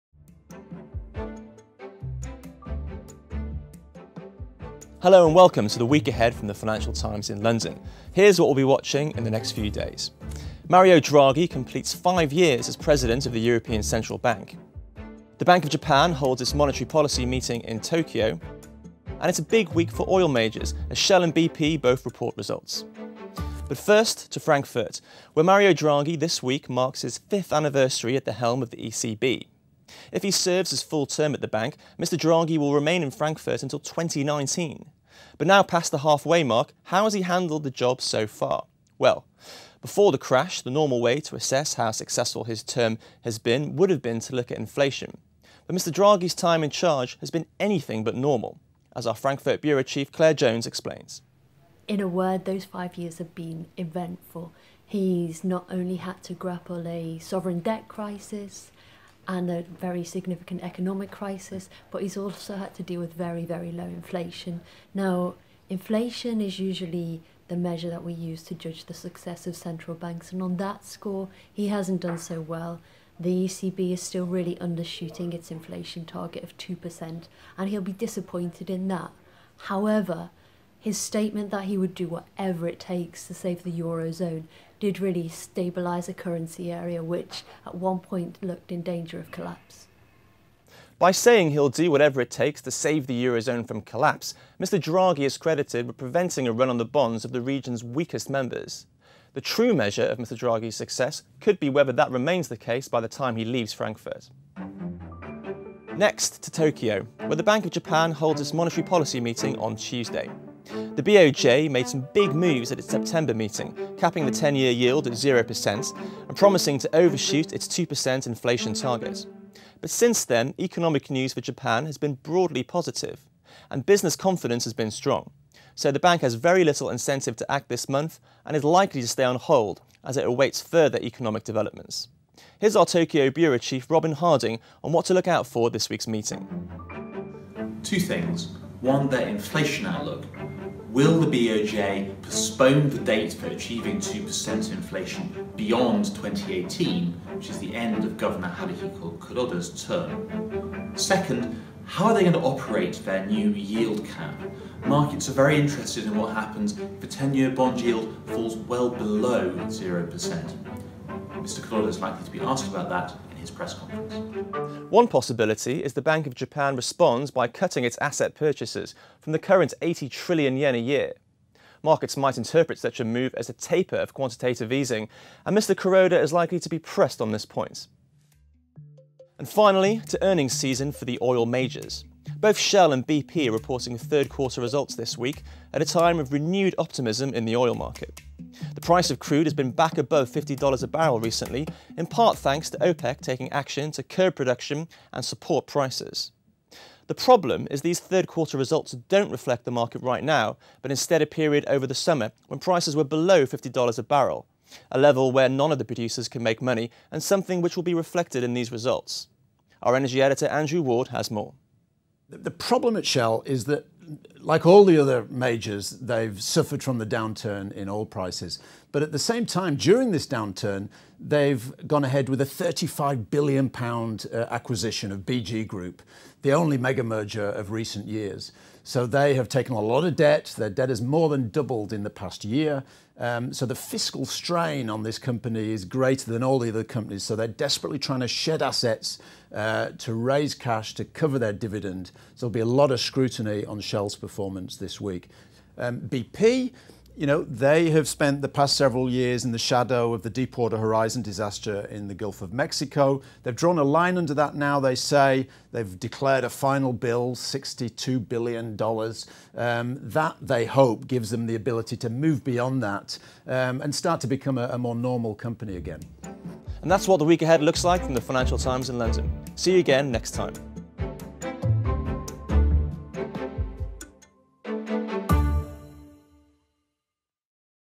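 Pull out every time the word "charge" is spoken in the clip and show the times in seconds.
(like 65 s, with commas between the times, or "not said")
46 s.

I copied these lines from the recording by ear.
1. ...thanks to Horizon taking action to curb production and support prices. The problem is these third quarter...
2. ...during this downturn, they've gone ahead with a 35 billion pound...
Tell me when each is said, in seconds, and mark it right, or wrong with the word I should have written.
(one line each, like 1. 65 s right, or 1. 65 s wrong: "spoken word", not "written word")
1. 192 s wrong: "OPEC", not "Horizon"
2. 219 s right.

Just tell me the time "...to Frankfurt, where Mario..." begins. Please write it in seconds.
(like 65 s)
24 s.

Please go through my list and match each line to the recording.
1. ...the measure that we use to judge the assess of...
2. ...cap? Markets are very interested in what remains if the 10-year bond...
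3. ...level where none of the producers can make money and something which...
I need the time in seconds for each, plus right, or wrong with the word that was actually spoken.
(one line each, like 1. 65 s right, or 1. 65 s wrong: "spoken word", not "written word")
1. 67 s wrong: "success", not "assess"
2. 154 s wrong: "happens", not "remains"
3. 204 s right.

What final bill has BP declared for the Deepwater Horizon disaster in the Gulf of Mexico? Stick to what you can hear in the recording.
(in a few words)
$62 billion.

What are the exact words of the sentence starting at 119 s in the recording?
But since then, economic news for Japan has been broadly positive, and business confidence has been strong.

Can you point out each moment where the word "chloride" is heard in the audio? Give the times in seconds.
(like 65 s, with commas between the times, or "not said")
not said.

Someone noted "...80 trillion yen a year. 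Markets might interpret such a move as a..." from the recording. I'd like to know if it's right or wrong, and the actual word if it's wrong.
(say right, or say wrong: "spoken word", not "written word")
right.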